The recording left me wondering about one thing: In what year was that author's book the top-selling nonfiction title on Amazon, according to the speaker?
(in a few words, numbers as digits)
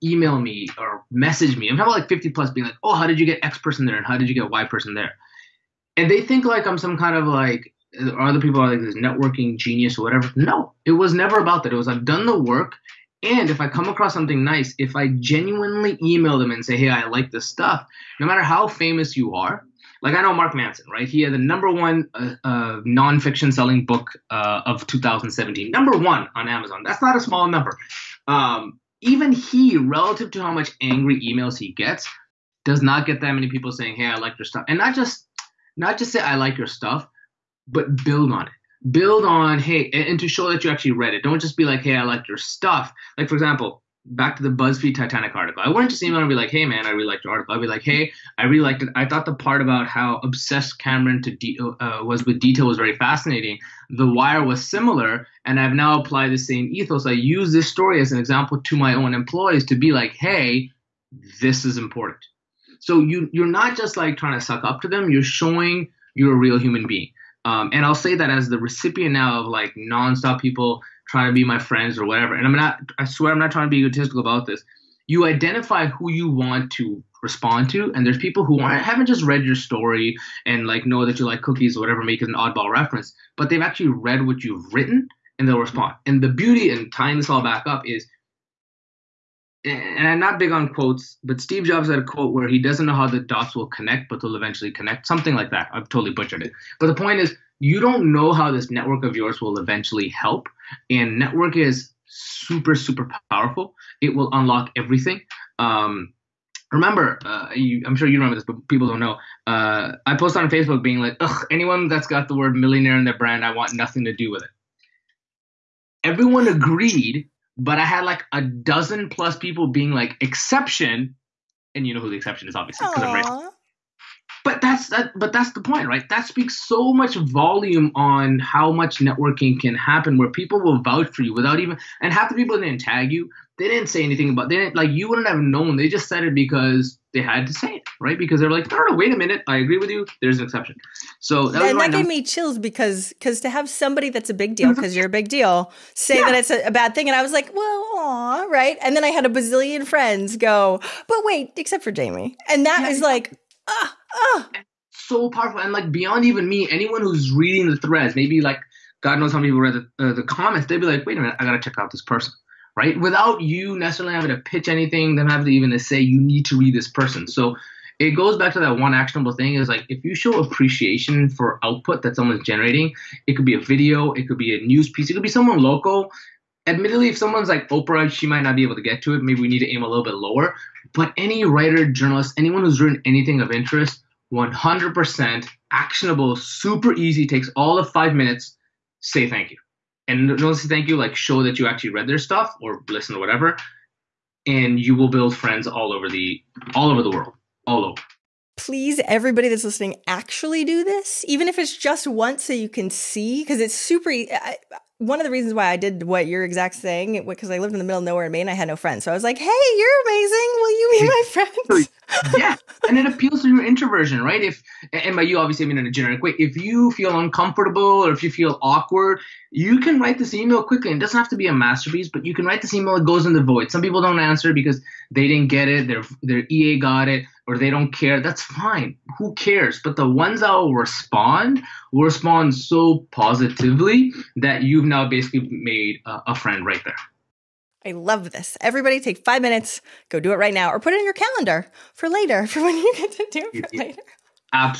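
2017.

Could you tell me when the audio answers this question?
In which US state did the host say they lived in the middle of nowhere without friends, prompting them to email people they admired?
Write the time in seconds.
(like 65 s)
208 s.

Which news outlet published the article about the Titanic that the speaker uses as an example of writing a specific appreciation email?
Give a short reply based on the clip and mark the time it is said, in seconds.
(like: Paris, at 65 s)
BuzzFeed, at 44 s.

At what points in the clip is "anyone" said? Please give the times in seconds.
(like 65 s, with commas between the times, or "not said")
111 s, 156 s, 182 s.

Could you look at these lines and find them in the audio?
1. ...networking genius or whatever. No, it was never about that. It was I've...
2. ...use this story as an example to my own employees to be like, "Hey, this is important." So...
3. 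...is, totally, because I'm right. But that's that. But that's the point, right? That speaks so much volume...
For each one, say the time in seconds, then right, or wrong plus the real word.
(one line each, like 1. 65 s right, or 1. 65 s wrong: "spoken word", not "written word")
1. 8 s right
2. 57 s right
3. 122 s wrong: "obviously", not "totally".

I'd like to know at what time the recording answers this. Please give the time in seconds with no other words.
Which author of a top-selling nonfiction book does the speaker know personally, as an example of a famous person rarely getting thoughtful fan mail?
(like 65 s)
20 s.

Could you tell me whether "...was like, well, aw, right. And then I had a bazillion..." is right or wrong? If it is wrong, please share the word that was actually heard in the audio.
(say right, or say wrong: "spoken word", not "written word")
right.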